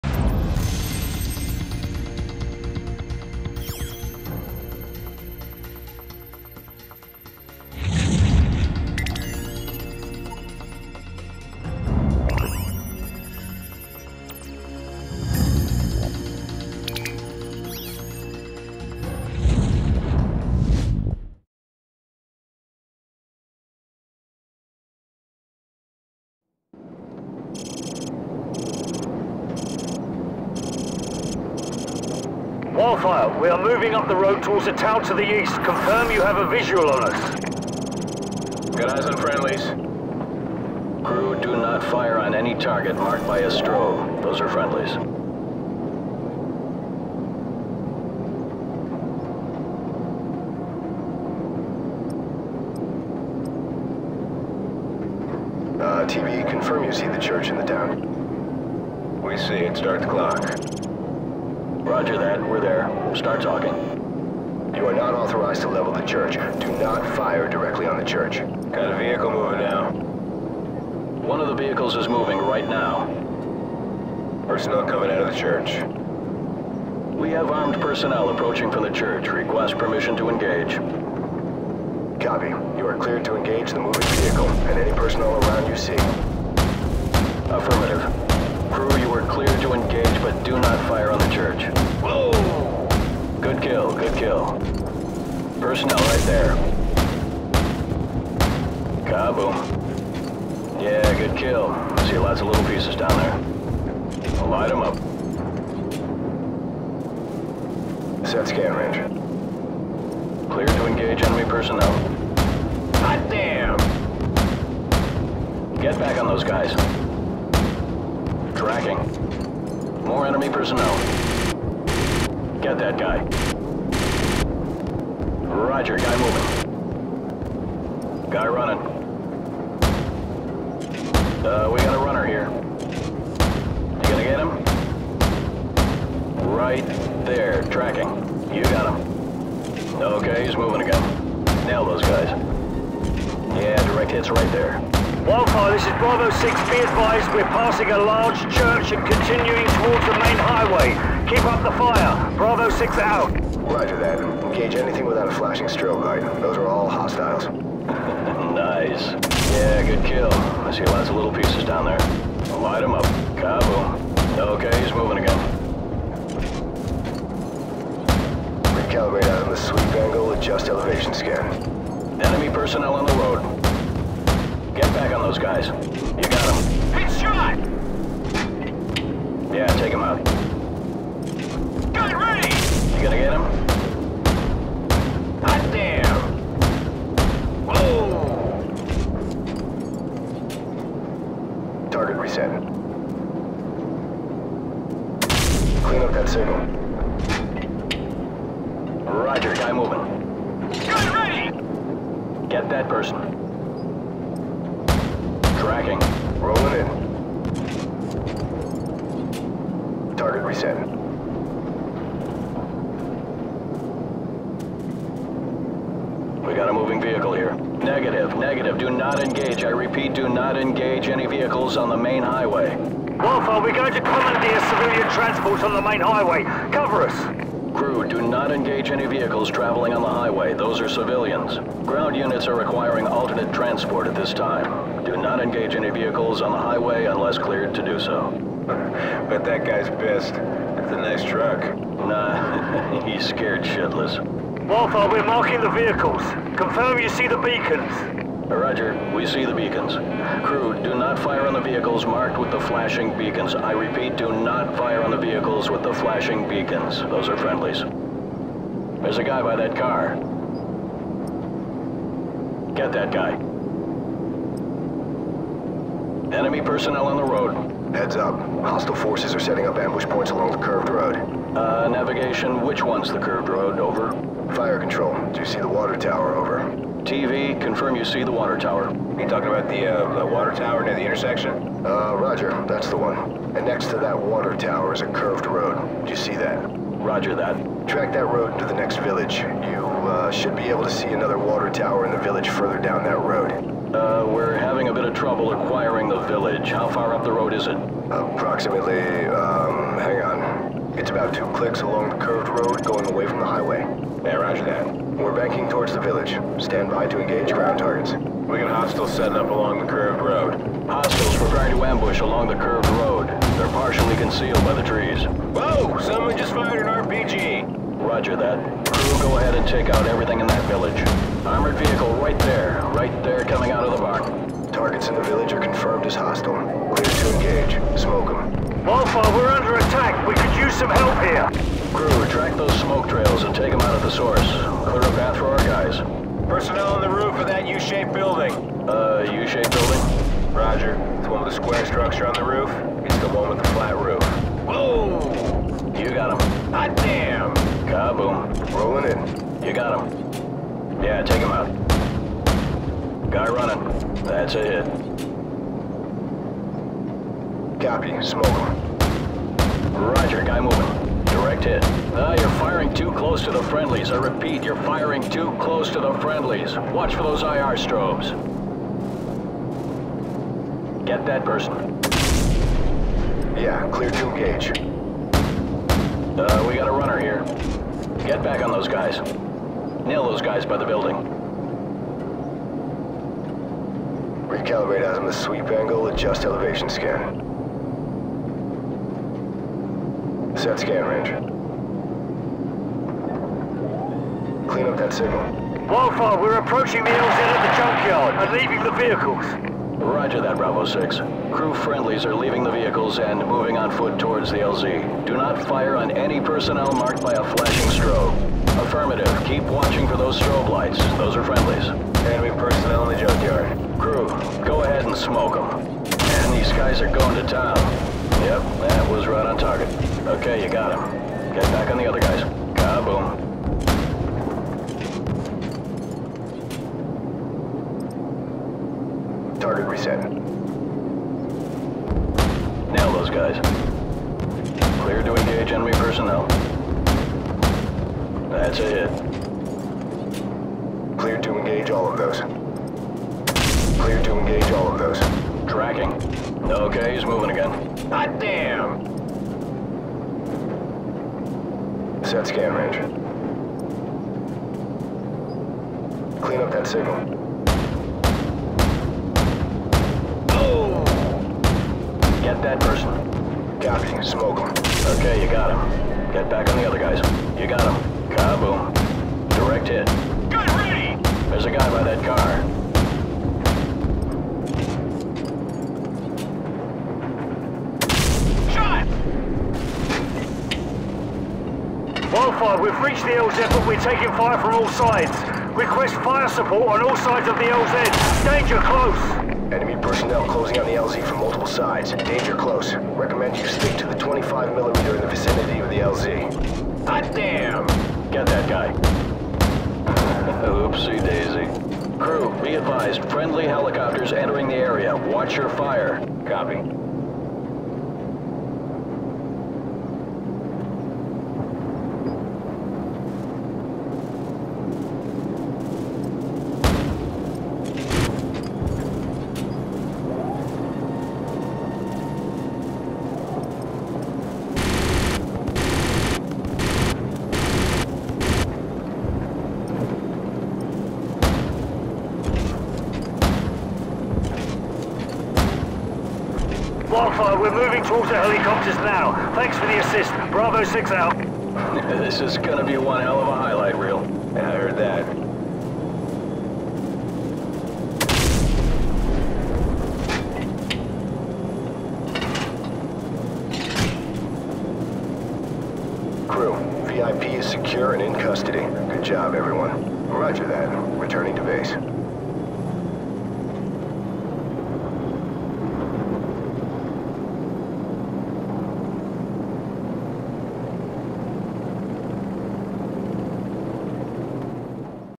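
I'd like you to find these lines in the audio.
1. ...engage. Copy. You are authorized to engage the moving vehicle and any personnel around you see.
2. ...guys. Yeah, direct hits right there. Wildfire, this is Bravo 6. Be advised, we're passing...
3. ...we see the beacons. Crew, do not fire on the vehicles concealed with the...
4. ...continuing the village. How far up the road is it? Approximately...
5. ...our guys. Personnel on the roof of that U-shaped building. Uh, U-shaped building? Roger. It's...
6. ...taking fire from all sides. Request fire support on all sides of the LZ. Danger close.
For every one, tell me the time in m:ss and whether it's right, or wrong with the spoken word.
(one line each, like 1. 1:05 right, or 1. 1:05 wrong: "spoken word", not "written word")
1. 1:20 wrong: "cleared", not "authorized"
2. 2:22 right
3. 4:09 wrong: "marked", not "concealed"
4. 4:55 wrong: "acquiring", not "continuing"
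5. 5:35 right
6. 8:04 right.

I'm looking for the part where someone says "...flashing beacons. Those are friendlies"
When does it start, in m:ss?
4:15.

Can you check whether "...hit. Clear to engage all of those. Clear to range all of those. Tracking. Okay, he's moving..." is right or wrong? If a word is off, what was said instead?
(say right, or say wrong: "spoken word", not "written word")
wrong: "engage", not "range".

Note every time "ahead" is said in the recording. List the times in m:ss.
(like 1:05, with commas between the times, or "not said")
5:19, 6:54.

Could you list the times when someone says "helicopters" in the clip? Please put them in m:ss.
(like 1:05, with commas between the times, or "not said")
8:23, 8:58.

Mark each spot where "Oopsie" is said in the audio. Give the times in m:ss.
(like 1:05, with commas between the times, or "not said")
8:20.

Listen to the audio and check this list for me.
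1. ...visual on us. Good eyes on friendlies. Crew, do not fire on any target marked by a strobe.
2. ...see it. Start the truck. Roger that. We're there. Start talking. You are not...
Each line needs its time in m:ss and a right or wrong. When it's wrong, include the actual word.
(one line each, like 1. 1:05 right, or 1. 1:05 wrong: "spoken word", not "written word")
1. 0:36 right
2. 0:59 wrong: "clock", not "truck".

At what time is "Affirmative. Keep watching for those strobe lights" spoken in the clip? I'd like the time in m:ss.
6:48.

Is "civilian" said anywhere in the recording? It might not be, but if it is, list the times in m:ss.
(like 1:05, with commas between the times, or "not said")
3:44, 3:50.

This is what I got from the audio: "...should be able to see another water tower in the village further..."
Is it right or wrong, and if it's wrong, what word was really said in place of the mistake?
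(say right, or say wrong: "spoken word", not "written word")
right.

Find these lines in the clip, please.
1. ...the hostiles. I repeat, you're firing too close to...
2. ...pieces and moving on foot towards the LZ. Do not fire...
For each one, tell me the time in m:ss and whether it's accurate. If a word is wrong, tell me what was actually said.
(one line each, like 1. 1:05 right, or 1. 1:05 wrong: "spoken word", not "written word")
1. 6:03 wrong: "friendlies", not "hostiles"
2. 6:42 wrong: "vehicles", not "pieces".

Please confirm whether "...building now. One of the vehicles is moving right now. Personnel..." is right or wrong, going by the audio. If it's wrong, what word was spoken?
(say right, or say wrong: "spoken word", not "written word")
wrong: "moving", not "building".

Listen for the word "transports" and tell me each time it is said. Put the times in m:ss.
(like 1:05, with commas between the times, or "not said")
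3:45, 3:53.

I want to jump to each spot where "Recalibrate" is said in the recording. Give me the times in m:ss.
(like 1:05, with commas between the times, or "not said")
2:48, 6:24.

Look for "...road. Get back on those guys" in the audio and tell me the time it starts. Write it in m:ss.
2:53.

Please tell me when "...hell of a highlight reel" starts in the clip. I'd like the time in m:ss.
9:03.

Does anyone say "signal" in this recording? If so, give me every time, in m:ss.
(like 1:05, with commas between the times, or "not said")
6:35, 7:36.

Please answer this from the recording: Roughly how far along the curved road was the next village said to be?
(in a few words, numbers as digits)
2 clicks.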